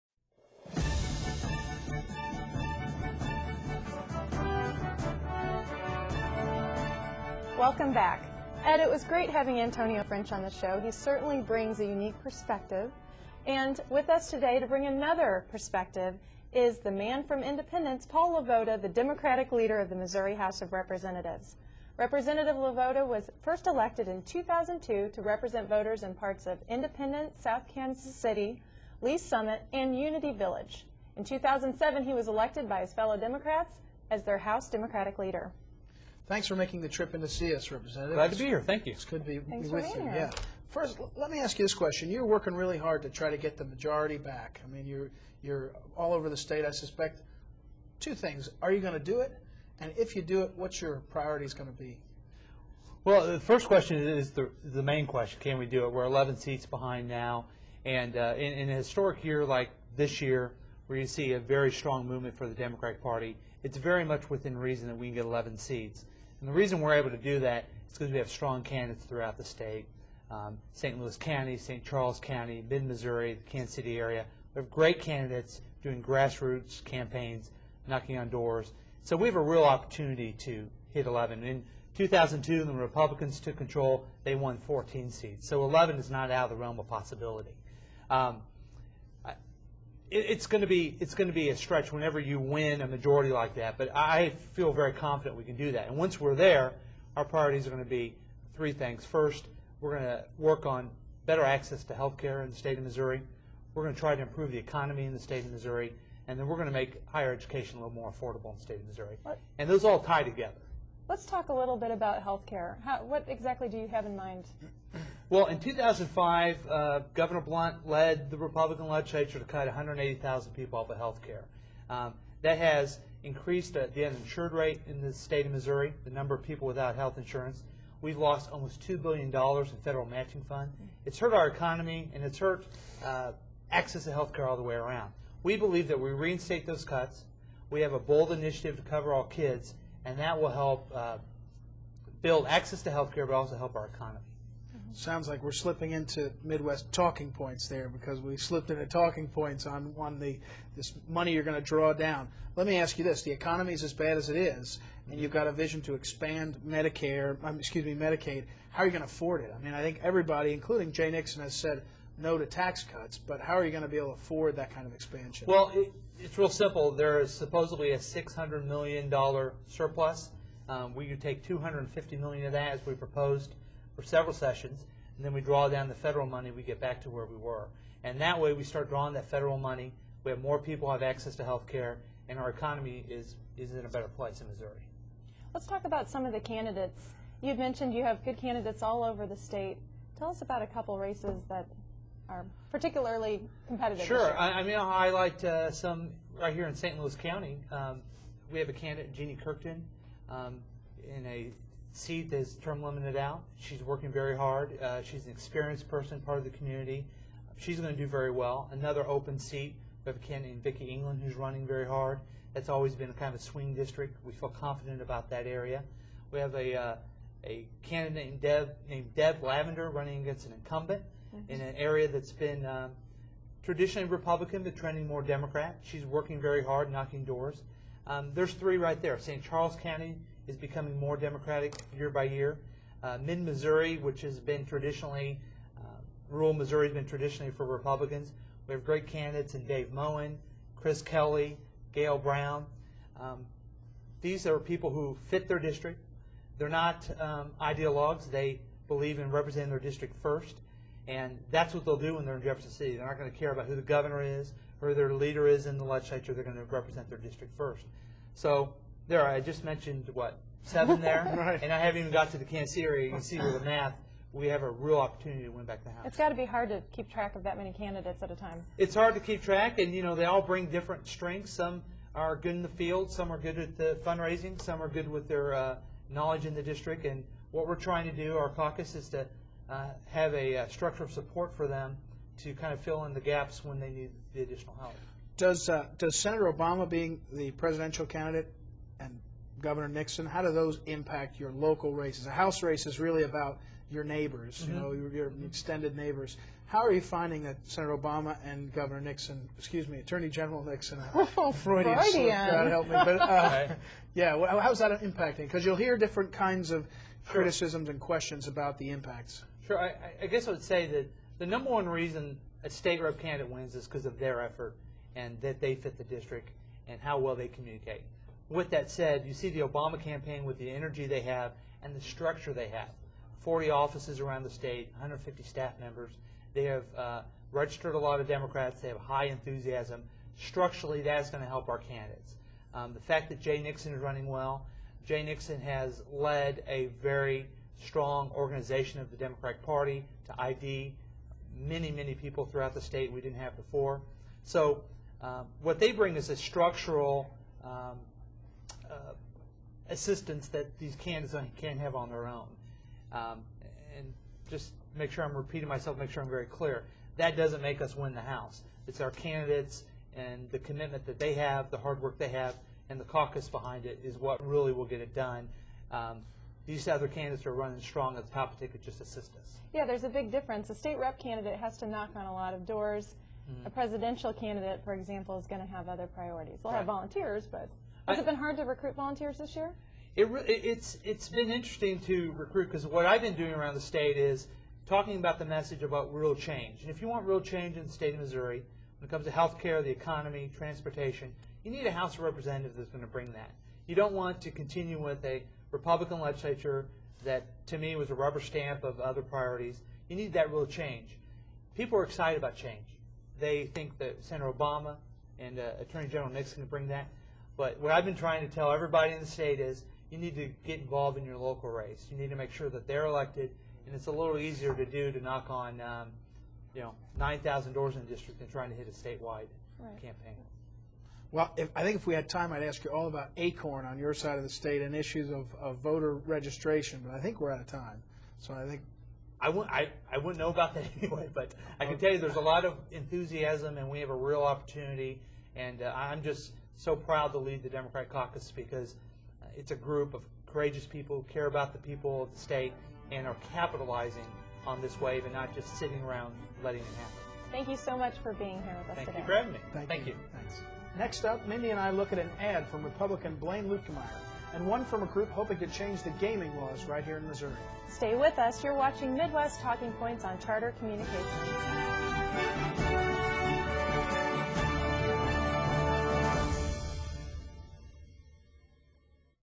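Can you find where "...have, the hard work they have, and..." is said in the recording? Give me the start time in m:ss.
6:01.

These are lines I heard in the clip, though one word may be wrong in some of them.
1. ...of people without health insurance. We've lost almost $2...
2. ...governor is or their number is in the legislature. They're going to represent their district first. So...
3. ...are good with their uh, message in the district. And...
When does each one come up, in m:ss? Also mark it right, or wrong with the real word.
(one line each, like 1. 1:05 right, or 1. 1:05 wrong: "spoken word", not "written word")
1. 2:06 right
2. 4:13 wrong: "leader", not "number"
3. 4:34 wrong: "knowledge", not "message".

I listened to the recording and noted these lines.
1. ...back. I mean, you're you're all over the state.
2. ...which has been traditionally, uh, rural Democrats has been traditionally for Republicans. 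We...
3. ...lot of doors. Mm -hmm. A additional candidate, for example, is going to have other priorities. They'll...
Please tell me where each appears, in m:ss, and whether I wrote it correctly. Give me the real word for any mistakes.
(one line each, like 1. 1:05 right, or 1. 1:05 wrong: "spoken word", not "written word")
1. 0:44 right
2. 3:53 wrong: "Missouri", not "Democrats"
3. 6:12 wrong: "presidential", not "additional".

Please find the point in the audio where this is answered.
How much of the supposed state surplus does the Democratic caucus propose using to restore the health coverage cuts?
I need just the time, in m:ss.
2:51.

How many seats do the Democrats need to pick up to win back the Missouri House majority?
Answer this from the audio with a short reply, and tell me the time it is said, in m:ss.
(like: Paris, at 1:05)
11, at 0:55.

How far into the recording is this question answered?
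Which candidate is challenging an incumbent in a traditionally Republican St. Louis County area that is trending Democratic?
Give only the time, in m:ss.
3:39.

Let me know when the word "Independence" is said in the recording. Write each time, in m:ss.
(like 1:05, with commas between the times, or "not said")
0:17, 0:26.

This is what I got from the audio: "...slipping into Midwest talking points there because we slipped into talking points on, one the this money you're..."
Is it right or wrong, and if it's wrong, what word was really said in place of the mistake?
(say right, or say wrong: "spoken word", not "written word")
right.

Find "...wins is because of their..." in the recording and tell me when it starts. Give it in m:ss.
5:13.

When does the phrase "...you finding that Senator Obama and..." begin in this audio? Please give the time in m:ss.
4:56.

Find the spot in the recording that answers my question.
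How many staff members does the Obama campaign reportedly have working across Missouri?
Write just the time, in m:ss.
5:24.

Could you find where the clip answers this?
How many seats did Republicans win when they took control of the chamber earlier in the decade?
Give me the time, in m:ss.
1:24.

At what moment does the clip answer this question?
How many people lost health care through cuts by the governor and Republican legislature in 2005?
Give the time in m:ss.
1:59.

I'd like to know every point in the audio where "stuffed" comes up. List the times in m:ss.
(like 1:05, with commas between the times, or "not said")
not said.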